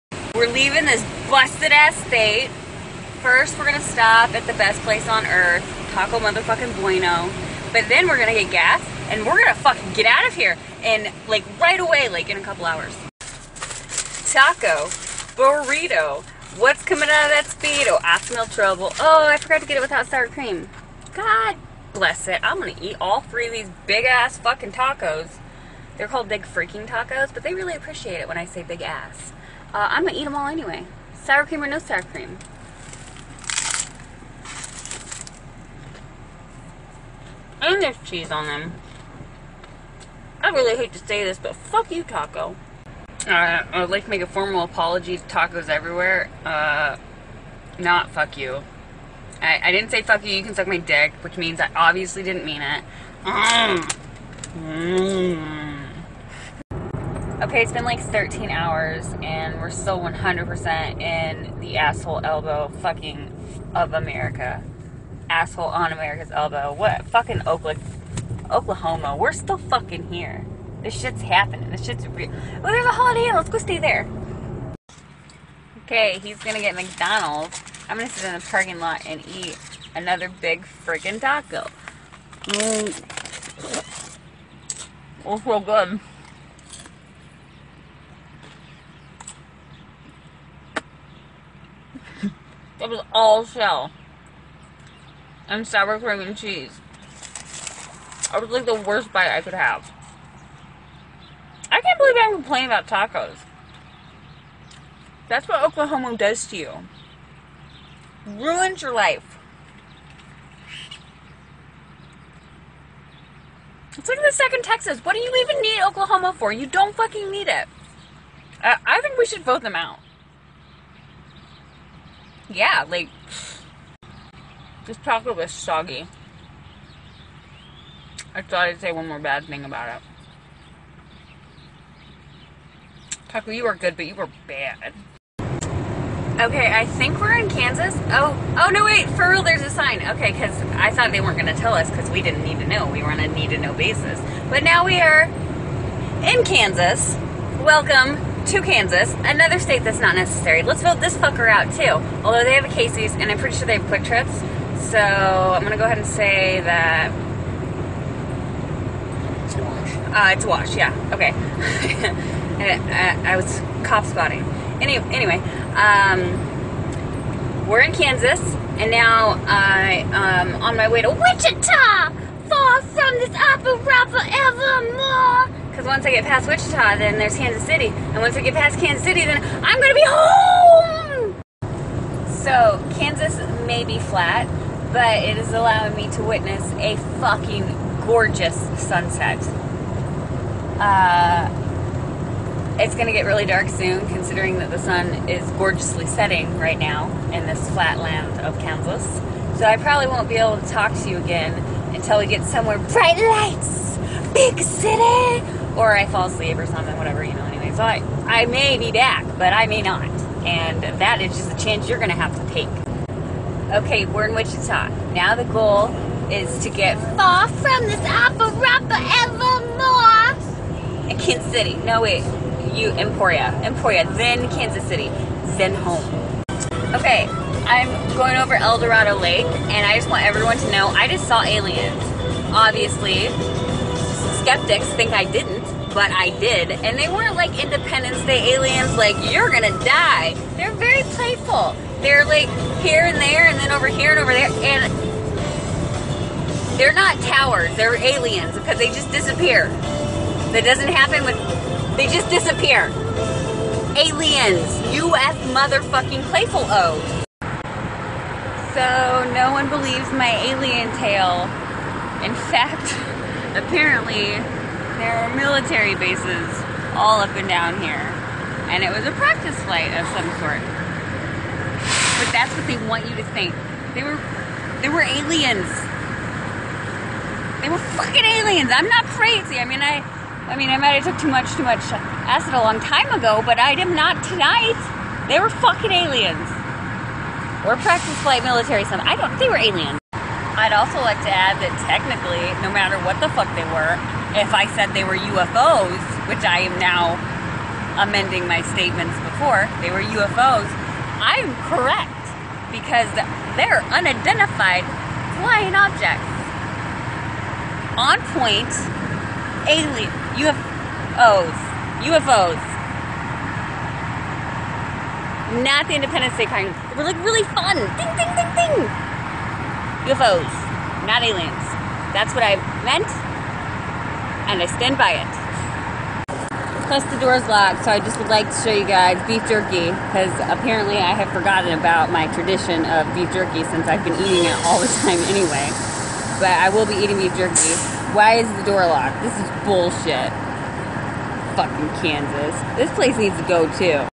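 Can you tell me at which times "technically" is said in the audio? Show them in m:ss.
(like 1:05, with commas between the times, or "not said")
4:51.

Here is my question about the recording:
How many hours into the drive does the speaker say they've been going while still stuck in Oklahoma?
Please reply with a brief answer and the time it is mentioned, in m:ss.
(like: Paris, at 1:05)
13, at 0:57.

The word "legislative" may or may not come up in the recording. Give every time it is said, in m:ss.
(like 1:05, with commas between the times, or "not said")
not said.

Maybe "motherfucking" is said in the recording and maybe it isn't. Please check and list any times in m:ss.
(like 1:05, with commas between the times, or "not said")
0:06, 4:15.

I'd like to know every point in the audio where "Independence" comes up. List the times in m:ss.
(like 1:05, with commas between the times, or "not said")
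3:57, 5:15.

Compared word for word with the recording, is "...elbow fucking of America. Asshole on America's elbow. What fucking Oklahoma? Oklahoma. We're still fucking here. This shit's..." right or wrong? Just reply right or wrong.
right.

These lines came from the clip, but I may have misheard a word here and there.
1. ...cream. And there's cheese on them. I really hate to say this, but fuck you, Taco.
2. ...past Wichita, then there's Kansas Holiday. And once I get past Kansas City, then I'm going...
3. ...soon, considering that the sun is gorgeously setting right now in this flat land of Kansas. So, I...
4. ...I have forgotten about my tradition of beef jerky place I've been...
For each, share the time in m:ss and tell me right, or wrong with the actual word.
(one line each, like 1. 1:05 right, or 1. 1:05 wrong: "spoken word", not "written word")
1. 0:32 right
2. 2:56 wrong: "City", not "Holiday"
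3. 3:13 right
4. 5:30 wrong: "since", not "place".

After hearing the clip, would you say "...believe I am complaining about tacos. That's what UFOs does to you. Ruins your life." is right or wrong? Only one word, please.
wrong.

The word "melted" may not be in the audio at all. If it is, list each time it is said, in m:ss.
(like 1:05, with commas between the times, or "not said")
not said.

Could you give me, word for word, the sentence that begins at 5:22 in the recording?
That's what I meant and I stand by it.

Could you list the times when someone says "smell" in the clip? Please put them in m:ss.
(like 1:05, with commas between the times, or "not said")
0:18.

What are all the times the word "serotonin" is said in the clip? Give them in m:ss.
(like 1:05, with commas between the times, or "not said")
not said.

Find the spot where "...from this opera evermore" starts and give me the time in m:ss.
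3:37.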